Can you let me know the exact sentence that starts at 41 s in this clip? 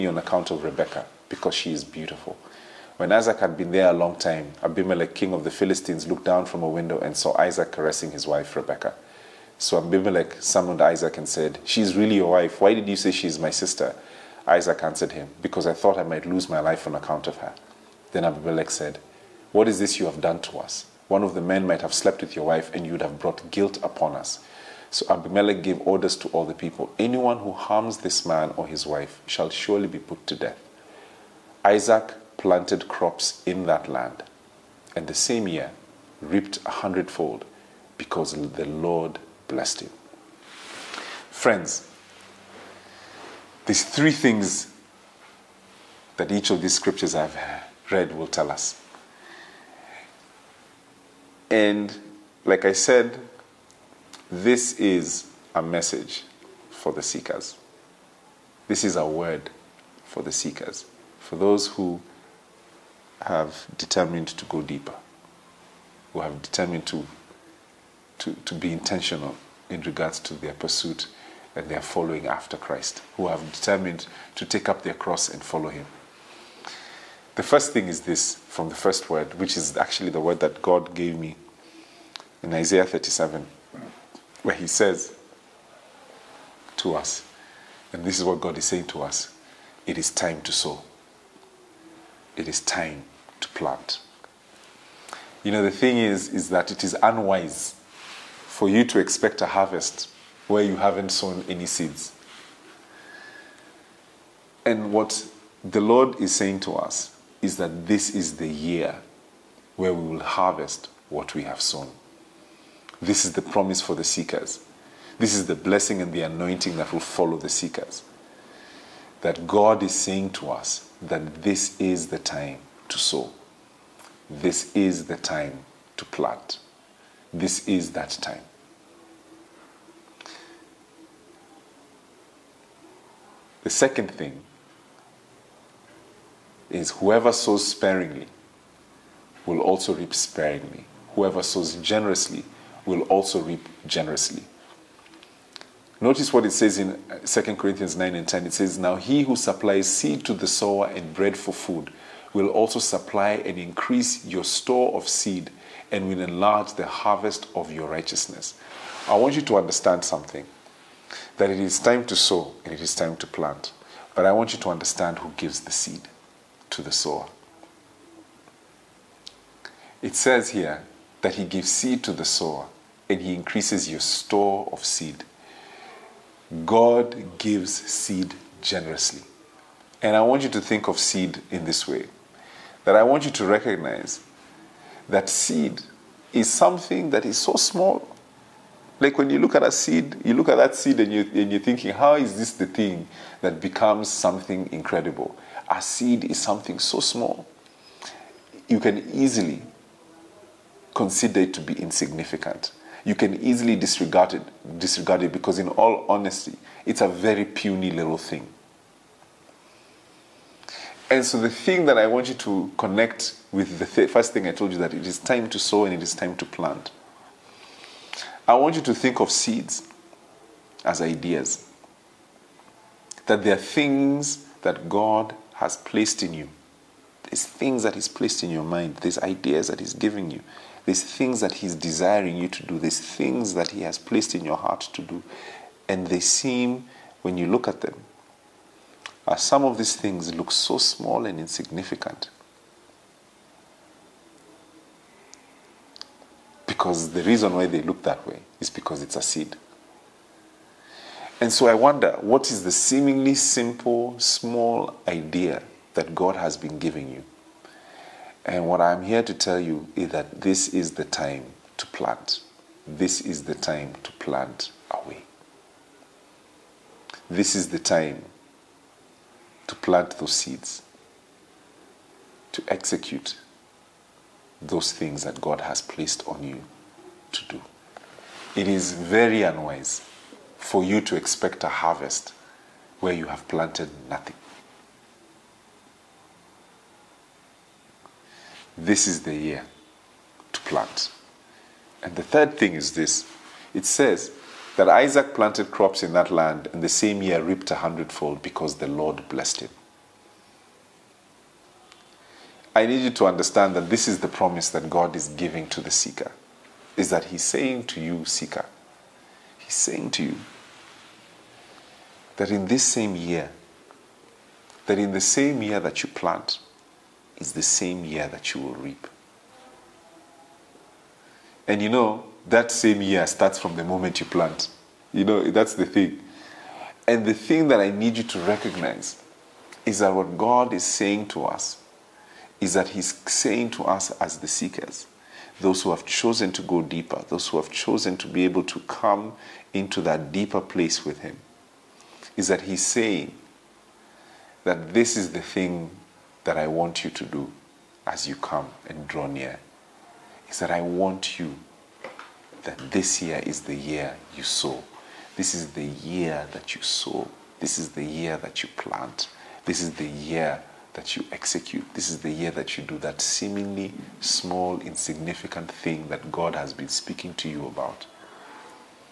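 Friends, these three things that each of these scriptures I've read will tell us.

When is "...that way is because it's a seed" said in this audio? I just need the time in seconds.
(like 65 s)
248 s.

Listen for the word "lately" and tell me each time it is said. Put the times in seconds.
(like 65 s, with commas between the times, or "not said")
not said.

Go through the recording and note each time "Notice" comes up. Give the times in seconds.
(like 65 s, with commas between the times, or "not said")
145 s.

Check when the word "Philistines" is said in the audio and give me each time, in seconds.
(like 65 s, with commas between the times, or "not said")
5 s.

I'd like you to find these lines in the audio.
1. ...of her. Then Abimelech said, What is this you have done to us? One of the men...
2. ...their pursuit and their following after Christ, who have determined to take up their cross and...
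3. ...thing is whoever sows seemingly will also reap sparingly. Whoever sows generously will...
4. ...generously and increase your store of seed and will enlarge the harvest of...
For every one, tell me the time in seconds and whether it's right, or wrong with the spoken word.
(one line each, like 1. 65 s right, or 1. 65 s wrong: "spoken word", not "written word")
1. 17 s right
2. 70 s right
3. 134 s wrong: "sparingly", not "seemingly"
4. 152 s wrong: "supply", not "generously".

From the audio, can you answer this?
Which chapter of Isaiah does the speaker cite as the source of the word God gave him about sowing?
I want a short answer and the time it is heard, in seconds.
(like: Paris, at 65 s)
37, at 82 s.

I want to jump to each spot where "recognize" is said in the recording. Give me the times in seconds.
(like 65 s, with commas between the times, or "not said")
183 s, 328 s.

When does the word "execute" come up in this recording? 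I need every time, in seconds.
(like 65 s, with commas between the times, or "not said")
272 s, 361 s.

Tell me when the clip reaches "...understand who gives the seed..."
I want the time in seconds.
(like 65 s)
164 s.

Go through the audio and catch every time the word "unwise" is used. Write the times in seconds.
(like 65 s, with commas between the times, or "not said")
97 s, 279 s.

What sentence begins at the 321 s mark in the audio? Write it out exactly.
And you know, that same year starts from the moment you plant.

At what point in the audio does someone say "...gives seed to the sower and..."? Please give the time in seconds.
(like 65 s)
171 s.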